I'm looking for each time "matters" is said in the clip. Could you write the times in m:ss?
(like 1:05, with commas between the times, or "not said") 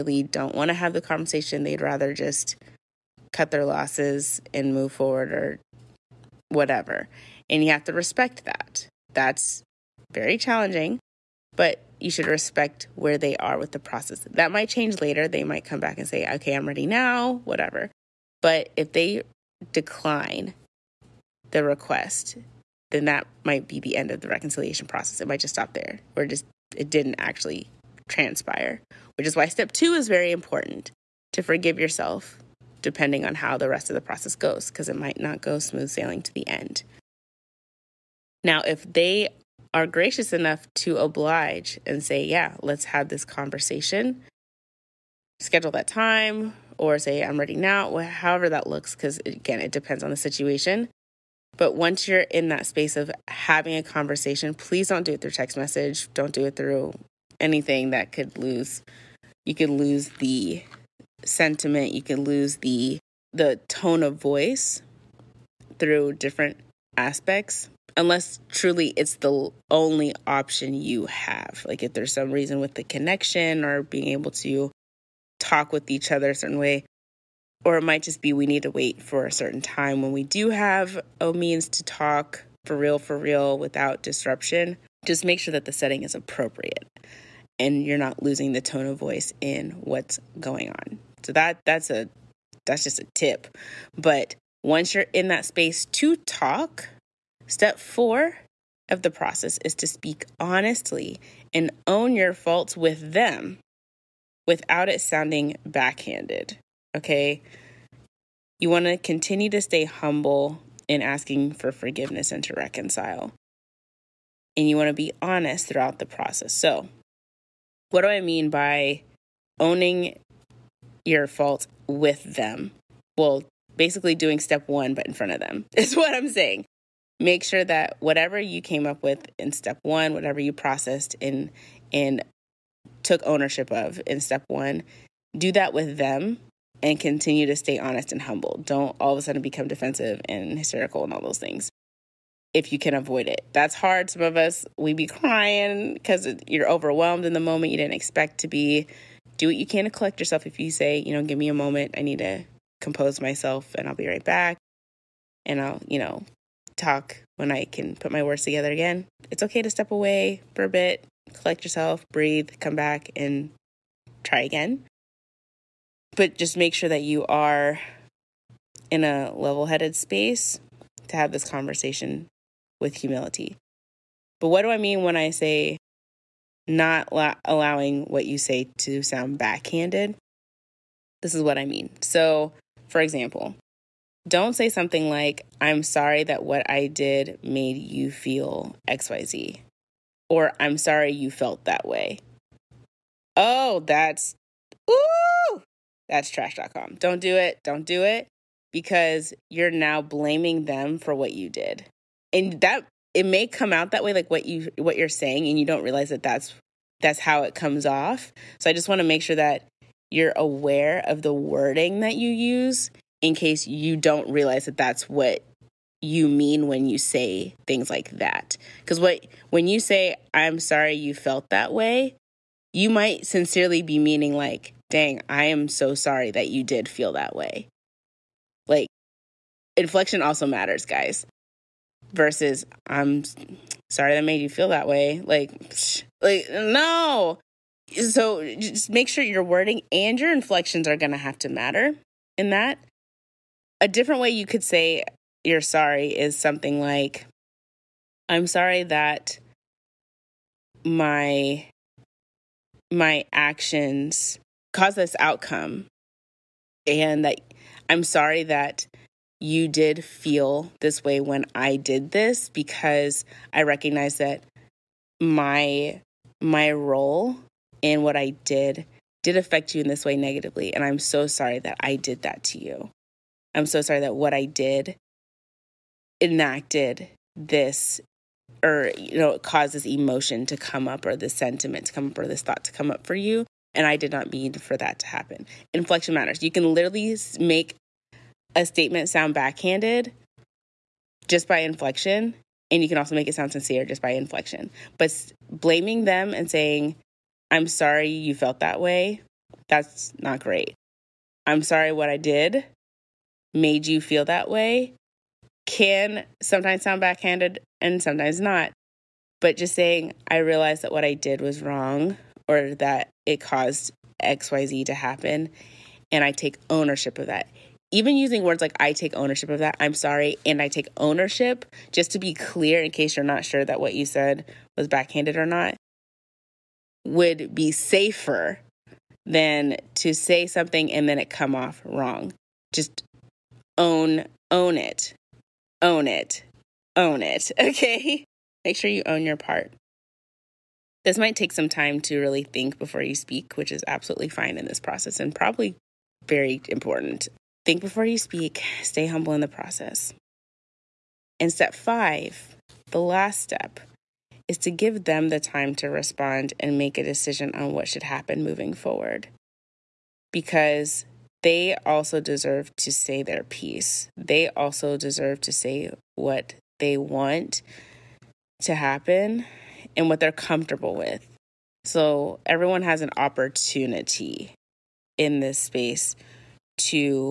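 3:50, 4:01, 4:46.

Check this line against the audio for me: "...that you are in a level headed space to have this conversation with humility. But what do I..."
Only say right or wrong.
right.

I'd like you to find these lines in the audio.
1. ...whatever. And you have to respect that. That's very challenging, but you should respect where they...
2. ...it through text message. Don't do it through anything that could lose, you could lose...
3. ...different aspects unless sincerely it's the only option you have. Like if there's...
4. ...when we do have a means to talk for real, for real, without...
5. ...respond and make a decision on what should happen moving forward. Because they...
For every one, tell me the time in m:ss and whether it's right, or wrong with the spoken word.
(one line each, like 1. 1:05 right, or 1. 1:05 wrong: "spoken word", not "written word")
1. 0:06 right
2. 0:55 right
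3. 1:06 wrong: "truly", not "sincerely"
4. 1:20 right
5. 5:55 right.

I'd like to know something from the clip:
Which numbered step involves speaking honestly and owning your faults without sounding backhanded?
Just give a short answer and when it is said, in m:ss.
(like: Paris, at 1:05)
Step four, at 1:37.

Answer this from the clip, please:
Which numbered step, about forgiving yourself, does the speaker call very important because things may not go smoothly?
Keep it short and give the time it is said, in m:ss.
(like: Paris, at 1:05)
Step two, at 0:29.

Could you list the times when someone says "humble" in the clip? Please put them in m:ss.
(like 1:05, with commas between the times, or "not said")
1:49, 2:18, 5:49.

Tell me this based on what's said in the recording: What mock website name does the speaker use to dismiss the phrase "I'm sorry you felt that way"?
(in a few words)
trash.com.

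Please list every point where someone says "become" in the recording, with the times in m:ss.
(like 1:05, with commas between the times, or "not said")
2:19.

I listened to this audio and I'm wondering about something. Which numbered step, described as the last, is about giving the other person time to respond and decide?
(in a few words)
Step five.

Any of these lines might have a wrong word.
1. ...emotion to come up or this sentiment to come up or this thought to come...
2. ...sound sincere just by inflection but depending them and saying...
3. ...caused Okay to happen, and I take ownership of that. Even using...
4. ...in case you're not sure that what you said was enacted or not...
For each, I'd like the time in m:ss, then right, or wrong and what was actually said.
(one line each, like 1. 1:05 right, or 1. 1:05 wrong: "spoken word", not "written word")
1. 4:39 right
2. 4:53 wrong: "blaming", not "depending"
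3. 5:13 wrong: "XYZ", not "Okay"
4. 5:22 wrong: "backhanded", not "enacted".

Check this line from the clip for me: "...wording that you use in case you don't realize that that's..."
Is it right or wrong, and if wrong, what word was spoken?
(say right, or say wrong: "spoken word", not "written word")
right.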